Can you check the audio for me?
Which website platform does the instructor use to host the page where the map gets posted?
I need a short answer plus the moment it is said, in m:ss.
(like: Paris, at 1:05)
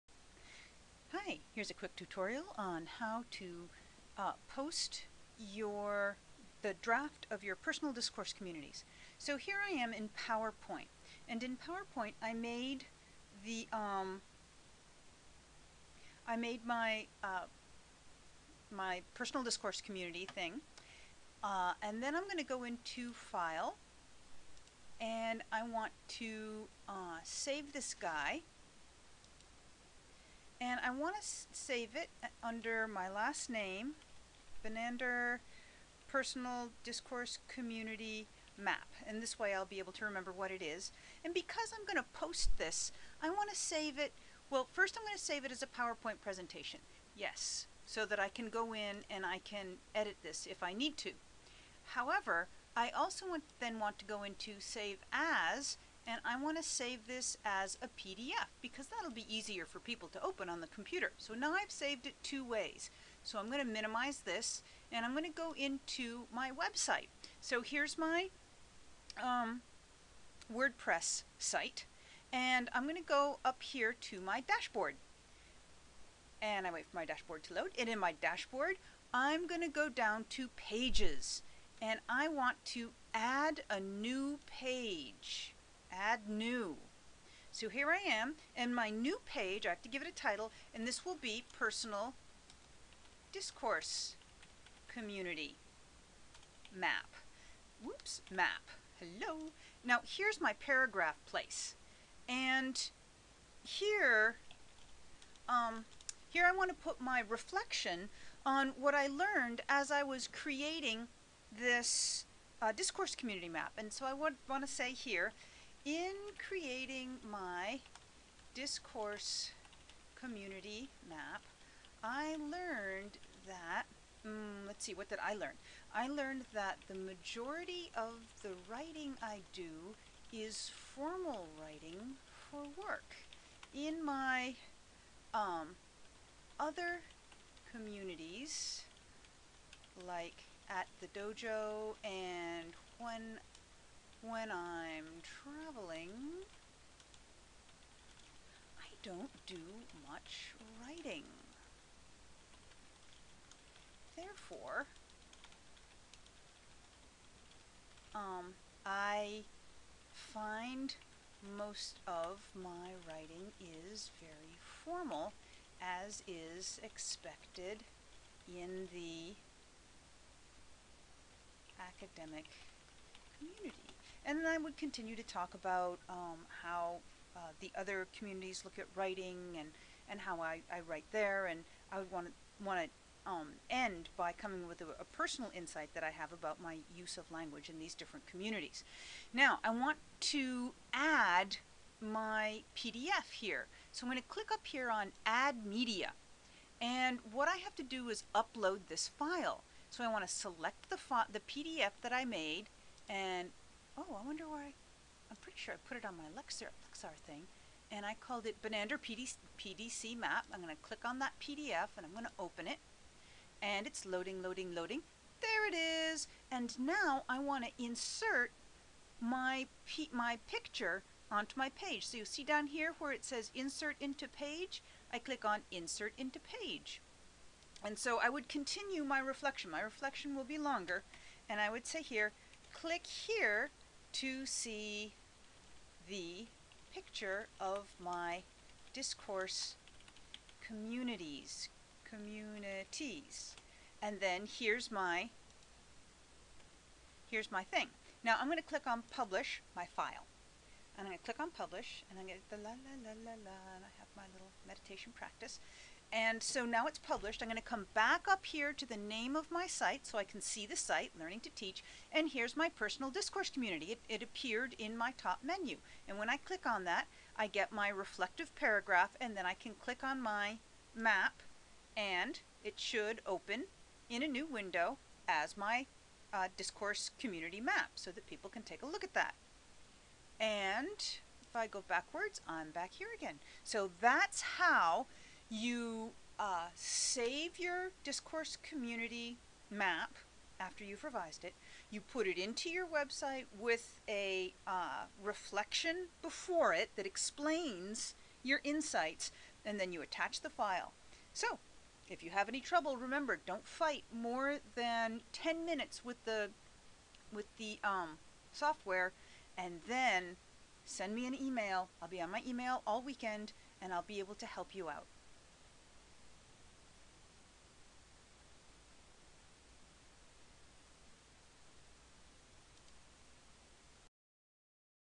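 WordPress, at 1:10.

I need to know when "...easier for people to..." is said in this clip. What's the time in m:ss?
0:59.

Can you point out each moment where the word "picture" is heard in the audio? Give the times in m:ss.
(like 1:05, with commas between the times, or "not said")
3:40, 3:56.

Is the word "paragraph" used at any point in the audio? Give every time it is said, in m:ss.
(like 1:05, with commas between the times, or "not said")
1:40, 4:28.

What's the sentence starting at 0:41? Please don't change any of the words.
And because I'm going to post this, I want to save it.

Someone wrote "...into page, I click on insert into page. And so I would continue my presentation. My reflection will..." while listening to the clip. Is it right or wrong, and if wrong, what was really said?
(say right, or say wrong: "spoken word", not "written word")
wrong: "reflection", not "presentation".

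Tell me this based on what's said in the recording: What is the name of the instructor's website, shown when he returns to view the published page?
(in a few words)
Learning to Teach.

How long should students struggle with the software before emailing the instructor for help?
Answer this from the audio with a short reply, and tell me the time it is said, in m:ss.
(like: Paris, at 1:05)
10 minutes, at 5:05.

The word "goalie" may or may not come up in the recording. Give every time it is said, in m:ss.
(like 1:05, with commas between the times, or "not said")
not said.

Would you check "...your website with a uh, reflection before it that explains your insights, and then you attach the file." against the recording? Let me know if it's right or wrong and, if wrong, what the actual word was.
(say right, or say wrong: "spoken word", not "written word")
right.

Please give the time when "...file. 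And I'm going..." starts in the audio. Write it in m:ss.
4:09.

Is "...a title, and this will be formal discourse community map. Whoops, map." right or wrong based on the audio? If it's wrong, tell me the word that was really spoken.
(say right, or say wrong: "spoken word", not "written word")
wrong: "personal", not "formal".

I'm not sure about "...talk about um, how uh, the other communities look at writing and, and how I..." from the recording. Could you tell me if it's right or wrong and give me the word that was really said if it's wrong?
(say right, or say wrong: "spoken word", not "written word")
right.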